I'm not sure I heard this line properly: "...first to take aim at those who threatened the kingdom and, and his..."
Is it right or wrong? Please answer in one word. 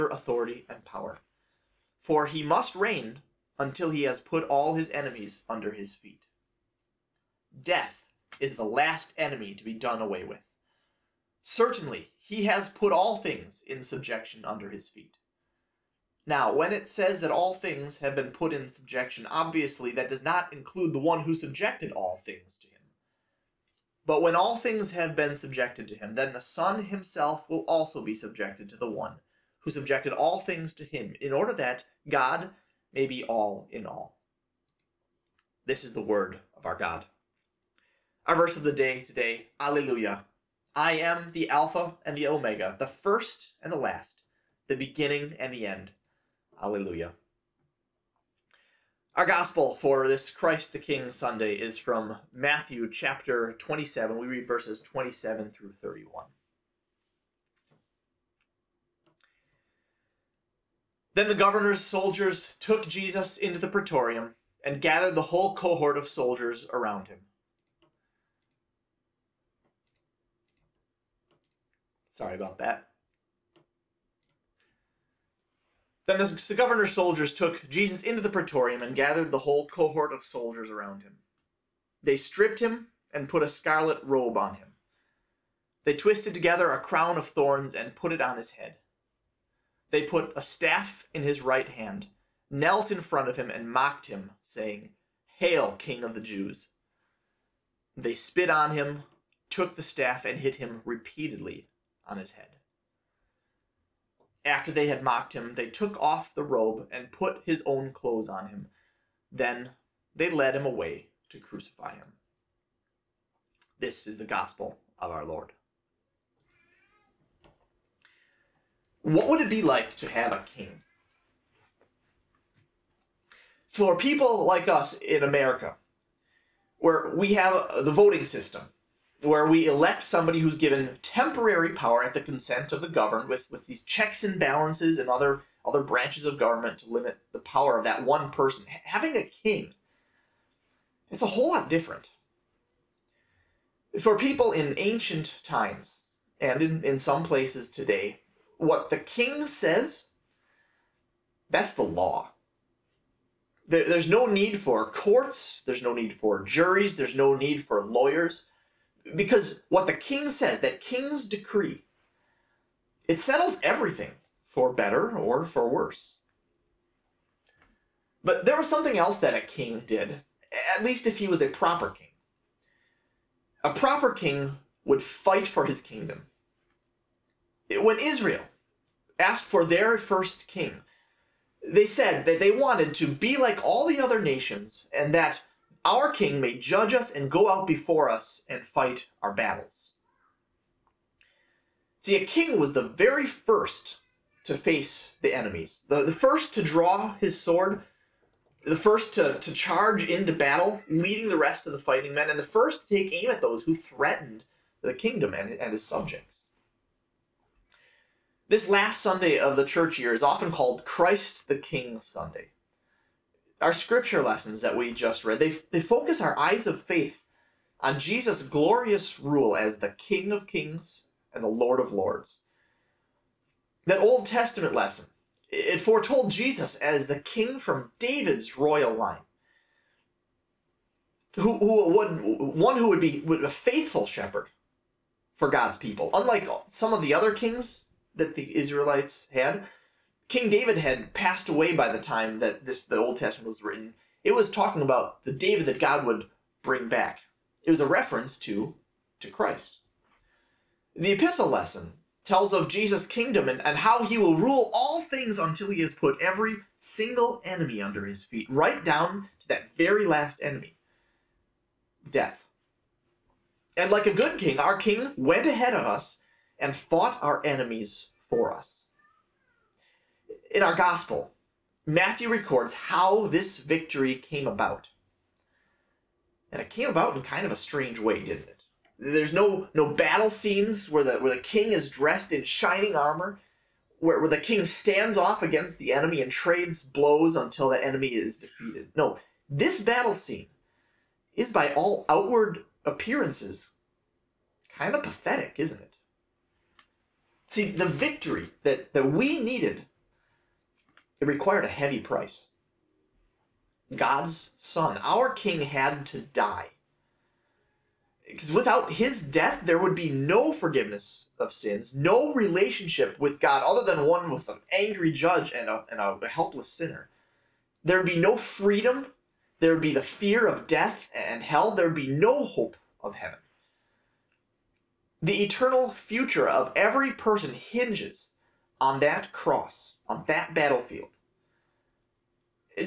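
right.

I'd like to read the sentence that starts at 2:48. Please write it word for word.
But there was something else that a king did, at least if he was a proper king.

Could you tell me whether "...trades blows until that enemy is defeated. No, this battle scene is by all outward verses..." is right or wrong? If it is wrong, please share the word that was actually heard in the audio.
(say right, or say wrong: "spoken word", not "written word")
wrong: "appearances", not "verses".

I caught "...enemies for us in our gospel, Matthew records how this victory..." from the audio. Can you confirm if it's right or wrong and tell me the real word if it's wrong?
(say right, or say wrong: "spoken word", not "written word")
right.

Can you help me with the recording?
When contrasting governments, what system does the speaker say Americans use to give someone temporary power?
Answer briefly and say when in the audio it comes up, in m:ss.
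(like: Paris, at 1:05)
The voting system, at 2:07.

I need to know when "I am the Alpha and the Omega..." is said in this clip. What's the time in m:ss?
0:40.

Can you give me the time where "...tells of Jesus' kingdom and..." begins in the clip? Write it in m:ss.
4:12.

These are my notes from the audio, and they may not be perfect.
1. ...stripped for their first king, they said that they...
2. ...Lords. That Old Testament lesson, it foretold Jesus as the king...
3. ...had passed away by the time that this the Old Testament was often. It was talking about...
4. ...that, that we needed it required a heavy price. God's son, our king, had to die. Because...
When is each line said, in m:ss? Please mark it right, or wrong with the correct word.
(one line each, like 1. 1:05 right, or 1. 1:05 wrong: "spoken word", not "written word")
1. 2:59 wrong: "asked", not "stripped"
2. 3:41 right
3. 4:00 wrong: "written", not "often"
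4. 4:58 right.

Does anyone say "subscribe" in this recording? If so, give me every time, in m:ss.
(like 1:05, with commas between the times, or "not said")
not said.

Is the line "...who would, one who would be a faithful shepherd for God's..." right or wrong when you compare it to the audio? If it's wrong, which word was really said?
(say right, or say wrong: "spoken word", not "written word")
right.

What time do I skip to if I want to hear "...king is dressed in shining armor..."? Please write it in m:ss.
4:41.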